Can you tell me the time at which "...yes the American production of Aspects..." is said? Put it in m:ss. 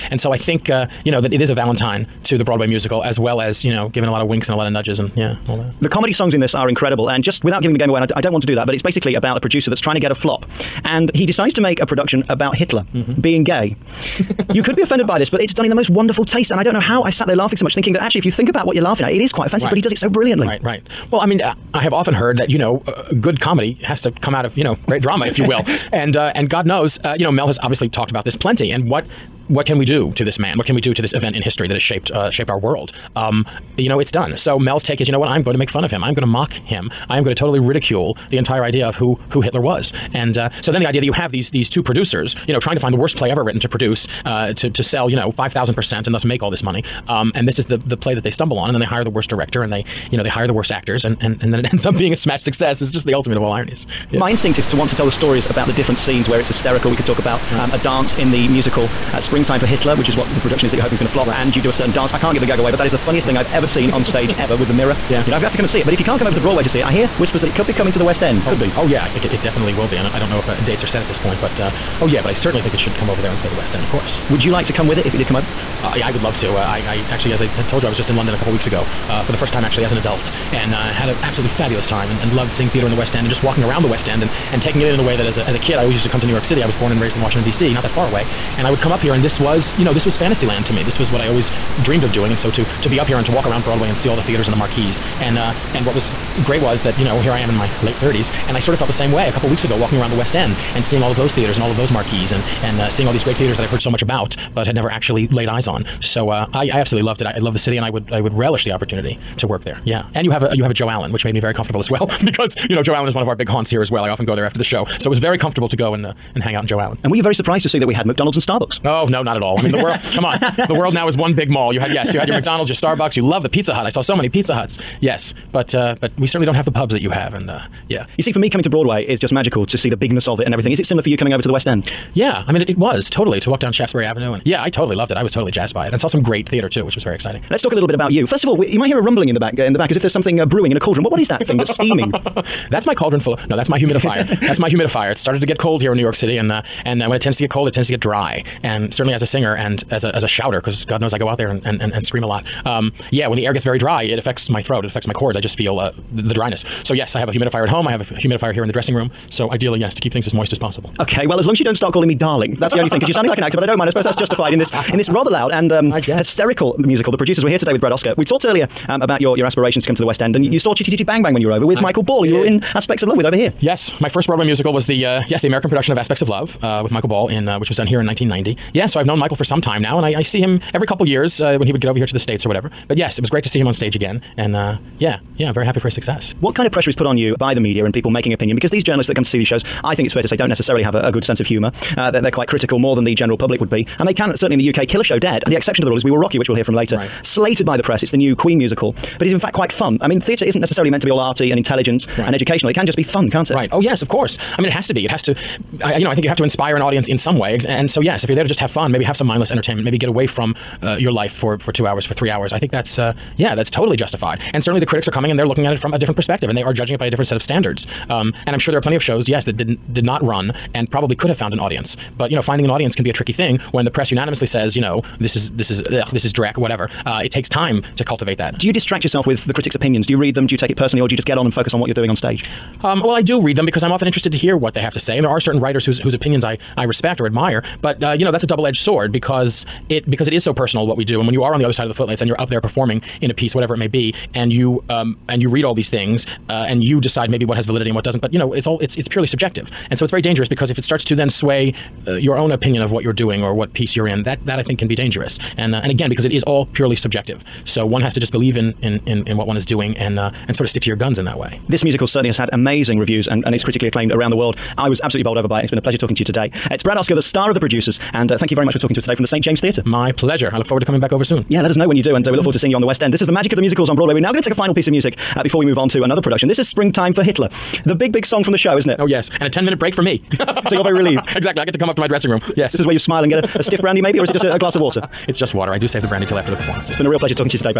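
2:55.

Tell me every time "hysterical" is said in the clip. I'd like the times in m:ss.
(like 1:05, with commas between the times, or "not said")
0:56, 2:45.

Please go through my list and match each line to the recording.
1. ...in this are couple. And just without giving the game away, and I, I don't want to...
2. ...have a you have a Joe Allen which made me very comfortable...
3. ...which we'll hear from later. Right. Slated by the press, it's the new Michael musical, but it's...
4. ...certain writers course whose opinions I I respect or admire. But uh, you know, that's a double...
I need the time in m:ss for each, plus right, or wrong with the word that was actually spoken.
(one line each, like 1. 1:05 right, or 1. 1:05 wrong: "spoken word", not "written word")
1. 0:06 wrong: "incredible", not "couple"
2. 1:50 right
3. 3:16 wrong: "Queen", not "Michael"
4. 3:55 wrong: "whose", not "course".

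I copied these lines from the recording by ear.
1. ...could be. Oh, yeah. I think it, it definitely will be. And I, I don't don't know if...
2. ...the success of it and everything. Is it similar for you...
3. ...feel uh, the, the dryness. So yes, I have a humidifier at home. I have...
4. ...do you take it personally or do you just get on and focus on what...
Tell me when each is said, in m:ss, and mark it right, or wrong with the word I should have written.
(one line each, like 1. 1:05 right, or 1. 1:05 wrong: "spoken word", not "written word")
1. 1:08 right
2. 2:09 wrong: "bigness", not "success"
3. 2:35 right
4. 3:50 right.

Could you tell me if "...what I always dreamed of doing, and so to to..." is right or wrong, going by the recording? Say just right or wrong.
right.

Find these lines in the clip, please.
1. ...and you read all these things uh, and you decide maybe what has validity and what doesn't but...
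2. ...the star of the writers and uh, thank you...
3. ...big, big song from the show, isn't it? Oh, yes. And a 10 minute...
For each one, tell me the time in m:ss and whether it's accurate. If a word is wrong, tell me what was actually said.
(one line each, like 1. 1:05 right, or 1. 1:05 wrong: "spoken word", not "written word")
1. 4:05 right
2. 4:27 wrong: "producers", not "writers"
3. 4:37 right.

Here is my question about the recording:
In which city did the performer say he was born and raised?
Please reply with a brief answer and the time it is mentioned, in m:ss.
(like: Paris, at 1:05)
Washington, D.C., at 1:27.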